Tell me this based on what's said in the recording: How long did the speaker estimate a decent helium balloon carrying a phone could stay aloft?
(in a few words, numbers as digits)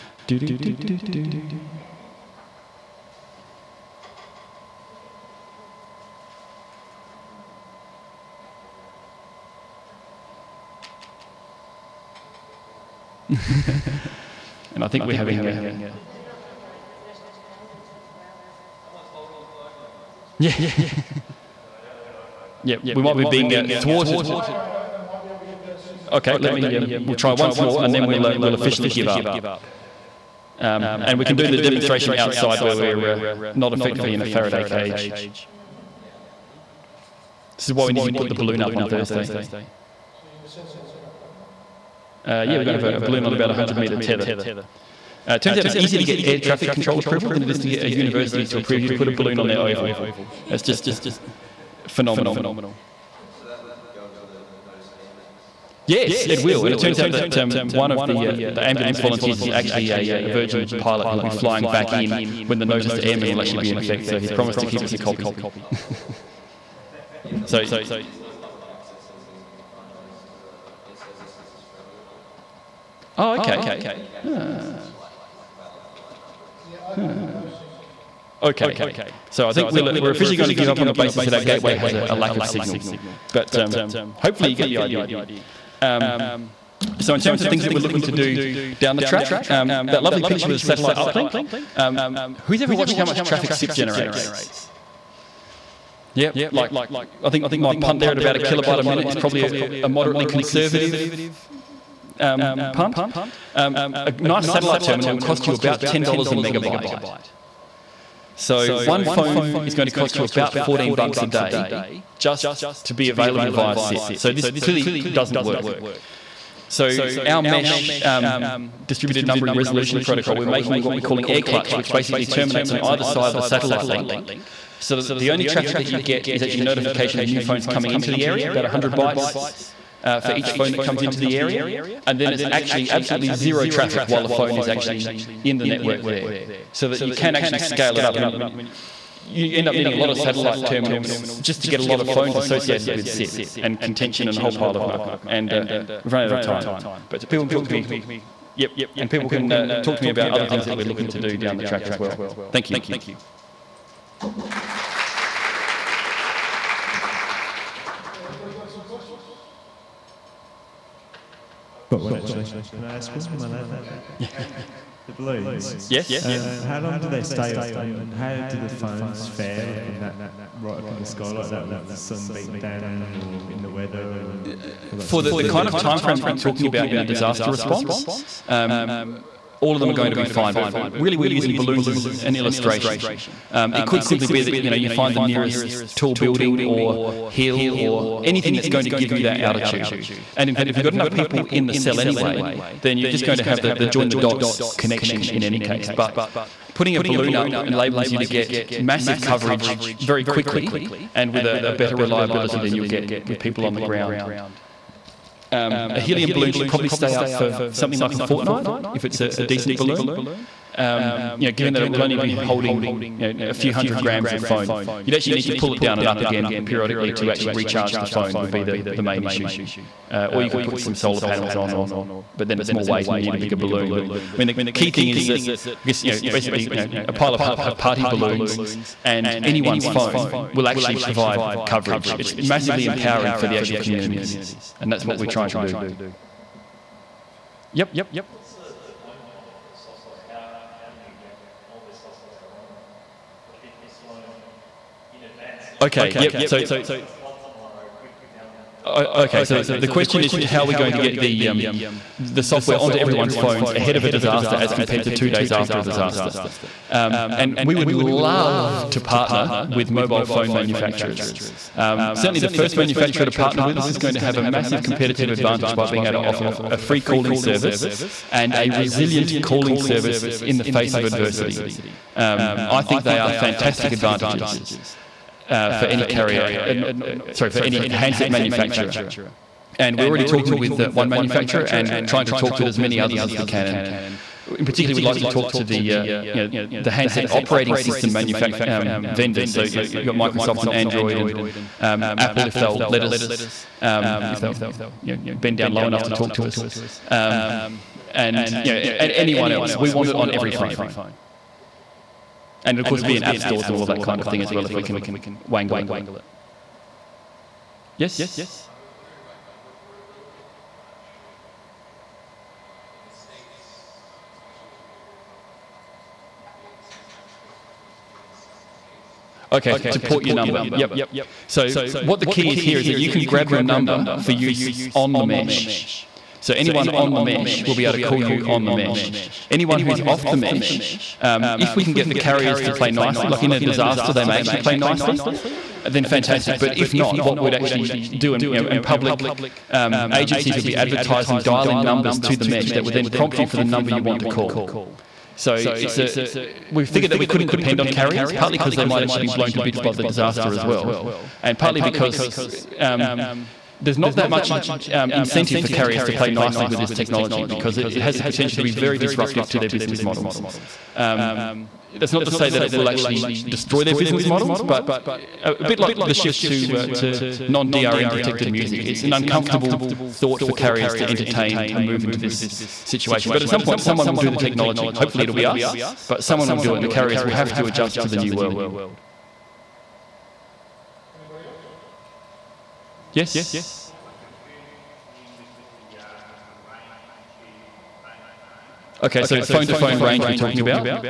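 a fortnight.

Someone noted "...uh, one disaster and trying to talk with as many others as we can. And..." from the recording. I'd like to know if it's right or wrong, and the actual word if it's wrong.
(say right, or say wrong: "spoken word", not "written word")
wrong: "manufacturer", not "disaster".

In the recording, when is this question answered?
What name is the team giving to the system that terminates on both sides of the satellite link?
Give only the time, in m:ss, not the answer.
2:01.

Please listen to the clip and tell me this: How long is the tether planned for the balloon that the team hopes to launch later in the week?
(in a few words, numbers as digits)
100 metres.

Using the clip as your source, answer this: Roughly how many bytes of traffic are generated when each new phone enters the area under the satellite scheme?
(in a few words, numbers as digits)
100 bytes.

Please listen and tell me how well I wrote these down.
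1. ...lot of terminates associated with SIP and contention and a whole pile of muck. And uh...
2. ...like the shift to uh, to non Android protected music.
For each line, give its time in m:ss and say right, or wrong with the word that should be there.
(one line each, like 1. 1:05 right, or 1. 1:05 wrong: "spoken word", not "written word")
1. 2:21 wrong: "phones", not "terminates"
2. 6:05 wrong: "DRM", not "Android".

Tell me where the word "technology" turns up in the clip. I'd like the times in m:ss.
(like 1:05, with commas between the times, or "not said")
5:56, 6:14.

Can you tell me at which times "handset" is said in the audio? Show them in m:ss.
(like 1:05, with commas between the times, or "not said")
4:37, 4:46.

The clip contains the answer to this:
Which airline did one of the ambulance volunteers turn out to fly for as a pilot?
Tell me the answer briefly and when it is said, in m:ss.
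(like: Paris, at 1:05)
Virgin, at 1:00.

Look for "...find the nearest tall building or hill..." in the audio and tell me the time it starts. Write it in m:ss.
3:04.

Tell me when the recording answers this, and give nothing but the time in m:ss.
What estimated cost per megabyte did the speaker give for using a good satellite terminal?
1:45.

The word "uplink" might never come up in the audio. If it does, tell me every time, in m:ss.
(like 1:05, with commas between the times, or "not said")
1:30.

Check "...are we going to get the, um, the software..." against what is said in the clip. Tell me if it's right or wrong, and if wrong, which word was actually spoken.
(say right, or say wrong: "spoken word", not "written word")
right.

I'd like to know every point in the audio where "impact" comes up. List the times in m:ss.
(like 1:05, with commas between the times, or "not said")
not said.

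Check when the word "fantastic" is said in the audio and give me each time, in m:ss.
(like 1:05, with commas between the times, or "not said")
4:33, 5:36.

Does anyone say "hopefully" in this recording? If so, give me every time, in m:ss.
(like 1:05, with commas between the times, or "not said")
1:24, 6:14.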